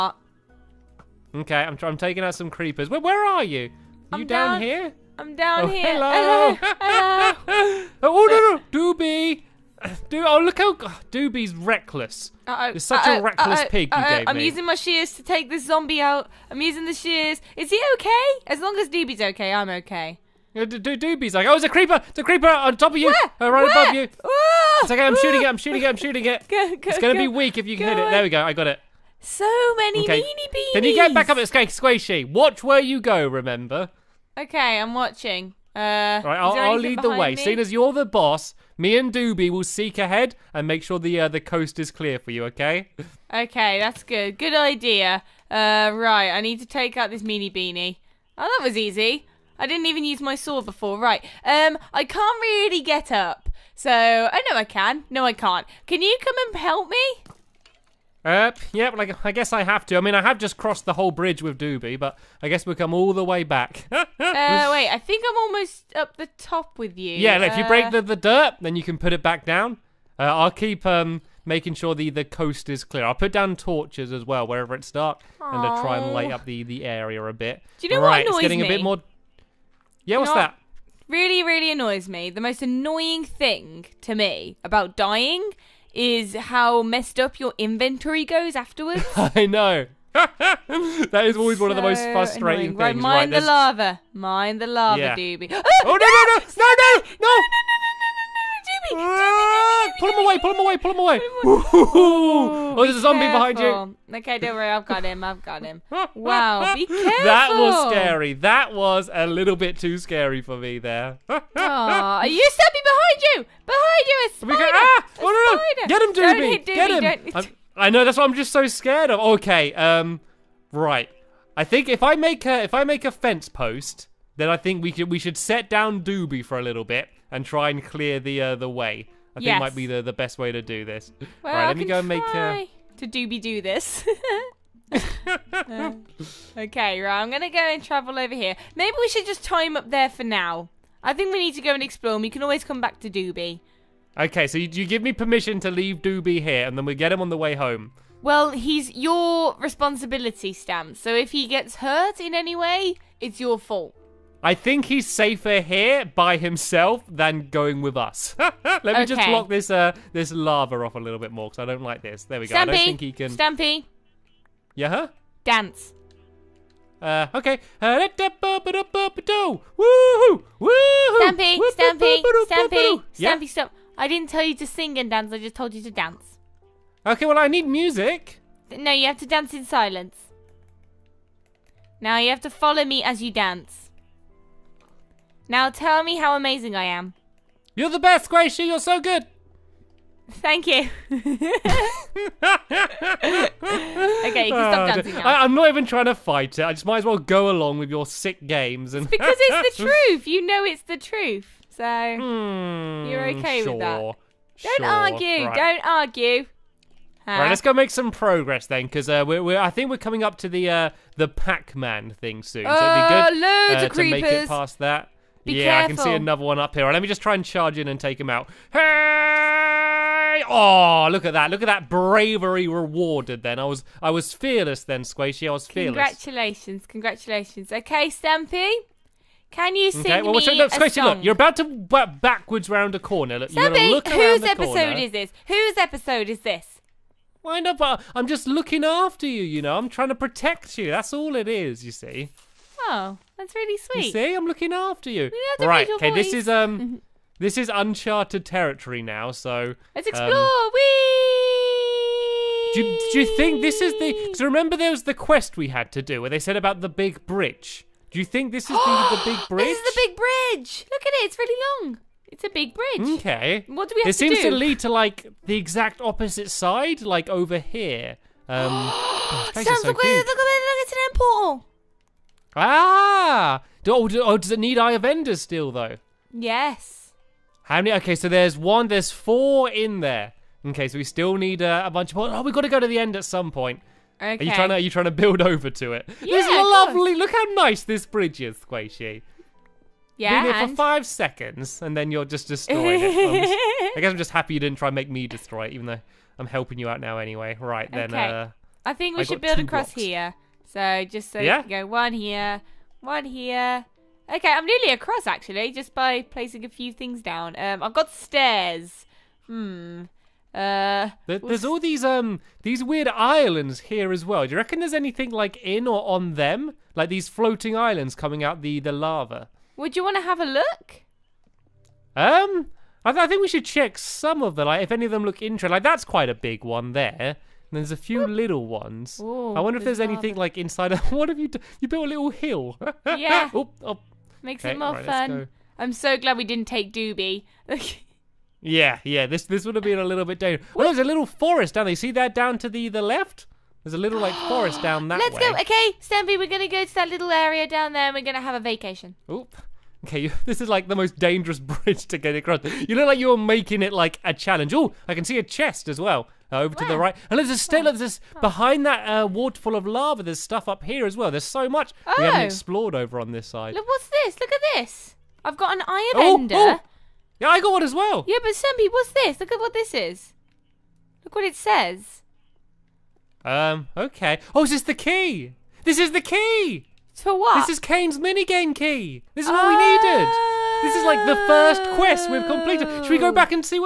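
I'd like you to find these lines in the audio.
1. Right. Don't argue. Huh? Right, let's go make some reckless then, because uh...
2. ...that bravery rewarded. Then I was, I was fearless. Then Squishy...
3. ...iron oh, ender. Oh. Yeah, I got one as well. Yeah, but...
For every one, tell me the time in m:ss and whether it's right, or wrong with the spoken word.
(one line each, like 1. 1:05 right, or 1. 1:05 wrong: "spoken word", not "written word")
1. 3:25 wrong: "progress", not "reckless"
2. 3:41 right
3. 6:05 right.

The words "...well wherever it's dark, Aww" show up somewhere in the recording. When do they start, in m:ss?
1:14.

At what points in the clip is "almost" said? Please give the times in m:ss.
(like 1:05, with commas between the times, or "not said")
1:05.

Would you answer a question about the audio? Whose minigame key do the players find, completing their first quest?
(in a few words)
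Kane's.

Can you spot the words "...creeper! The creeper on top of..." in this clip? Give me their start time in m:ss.
0:21.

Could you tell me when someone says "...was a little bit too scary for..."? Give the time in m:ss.
1:48.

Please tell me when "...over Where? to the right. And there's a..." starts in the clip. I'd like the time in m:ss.
5:56.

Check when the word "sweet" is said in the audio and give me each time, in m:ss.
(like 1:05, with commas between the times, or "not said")
4:03.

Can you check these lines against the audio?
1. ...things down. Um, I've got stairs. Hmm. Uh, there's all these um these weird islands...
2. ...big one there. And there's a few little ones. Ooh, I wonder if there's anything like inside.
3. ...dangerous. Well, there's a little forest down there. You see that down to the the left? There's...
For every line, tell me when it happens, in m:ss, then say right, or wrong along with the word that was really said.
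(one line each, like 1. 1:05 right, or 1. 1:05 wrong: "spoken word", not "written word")
1. 5:06 right
2. 5:26 right
3. 5:40 right.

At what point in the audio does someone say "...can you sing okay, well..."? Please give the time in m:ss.
3:49.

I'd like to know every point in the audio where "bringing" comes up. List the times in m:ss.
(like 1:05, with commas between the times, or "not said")
not said.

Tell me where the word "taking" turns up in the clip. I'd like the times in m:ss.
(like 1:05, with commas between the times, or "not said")
0:01.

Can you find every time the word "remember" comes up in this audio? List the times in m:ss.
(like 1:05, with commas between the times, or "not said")
0:33, 4:14.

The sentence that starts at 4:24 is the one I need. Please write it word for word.
It seems to lead to like the exact opposite side, like over here.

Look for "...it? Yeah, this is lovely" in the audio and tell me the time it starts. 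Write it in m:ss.
4:45.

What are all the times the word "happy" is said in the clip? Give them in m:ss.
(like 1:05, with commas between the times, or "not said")
4:54.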